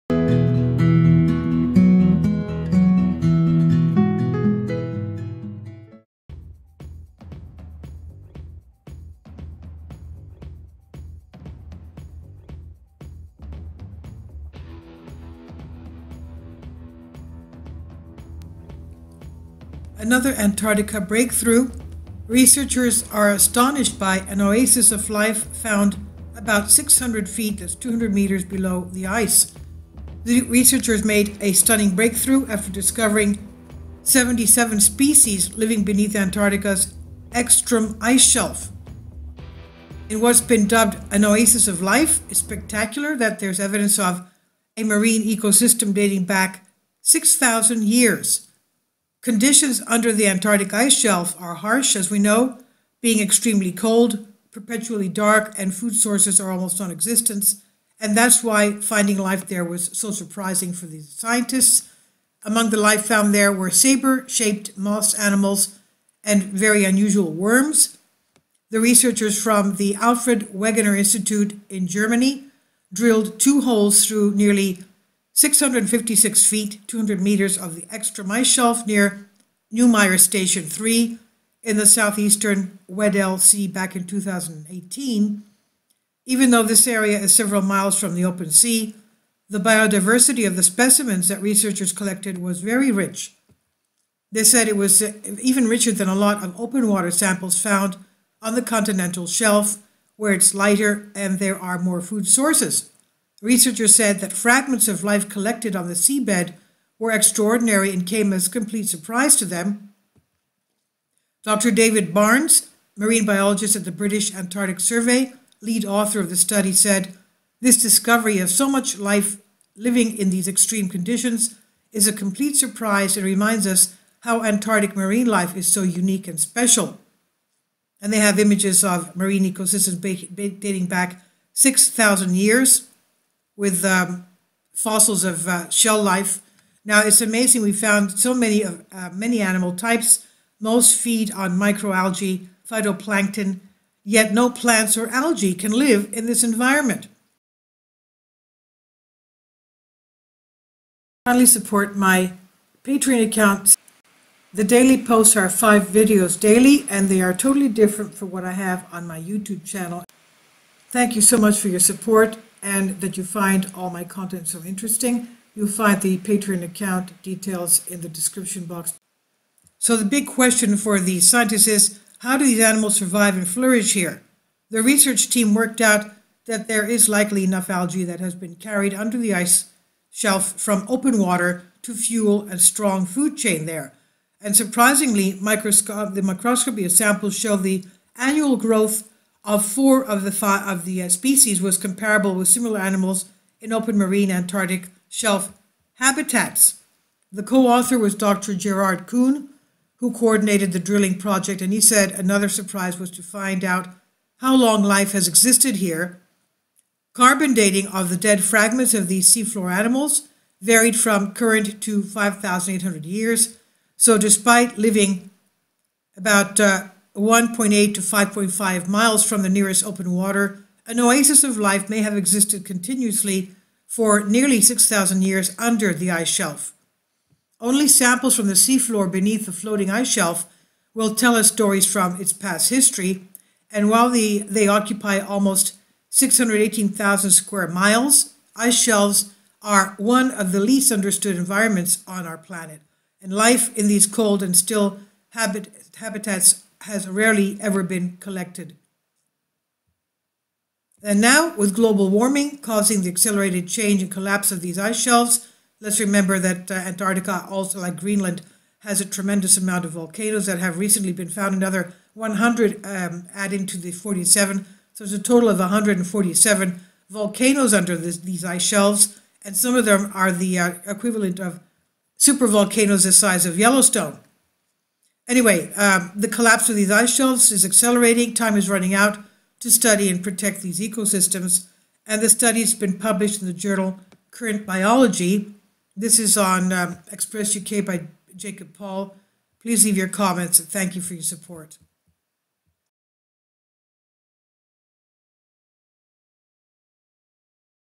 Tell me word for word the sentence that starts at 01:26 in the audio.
Even though this area is several miles from the open sea, the biodiversity of the specimens that researchers collected was very rich.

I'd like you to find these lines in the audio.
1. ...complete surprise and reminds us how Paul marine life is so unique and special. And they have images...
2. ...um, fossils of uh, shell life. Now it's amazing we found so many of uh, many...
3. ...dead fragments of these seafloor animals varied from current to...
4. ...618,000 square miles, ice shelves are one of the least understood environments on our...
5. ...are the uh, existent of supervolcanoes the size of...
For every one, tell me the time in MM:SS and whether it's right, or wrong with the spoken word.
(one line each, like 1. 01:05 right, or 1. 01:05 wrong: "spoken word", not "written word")
1. 02:02 wrong: "Antarctic", not "Paul"
2. 02:13 right
3. 03:28 right
4. 03:56 right
5. 04:30 wrong: "equivalent", not "existent".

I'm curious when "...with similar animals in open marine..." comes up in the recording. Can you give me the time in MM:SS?
03:12.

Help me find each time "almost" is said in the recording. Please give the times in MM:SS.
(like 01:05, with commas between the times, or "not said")
00:56, 03:55.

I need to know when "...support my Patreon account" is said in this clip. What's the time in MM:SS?
02:31.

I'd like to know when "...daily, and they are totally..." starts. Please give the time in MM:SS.
02:36.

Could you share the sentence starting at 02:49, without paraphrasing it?
So the big question for the scientists is, how do these animals survive and flourish here?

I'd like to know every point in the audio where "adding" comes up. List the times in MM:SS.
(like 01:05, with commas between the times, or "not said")
04:23.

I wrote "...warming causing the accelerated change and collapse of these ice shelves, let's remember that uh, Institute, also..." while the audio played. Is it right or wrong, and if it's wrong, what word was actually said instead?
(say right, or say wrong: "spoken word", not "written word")
wrong: "Antarctica", not "Institute".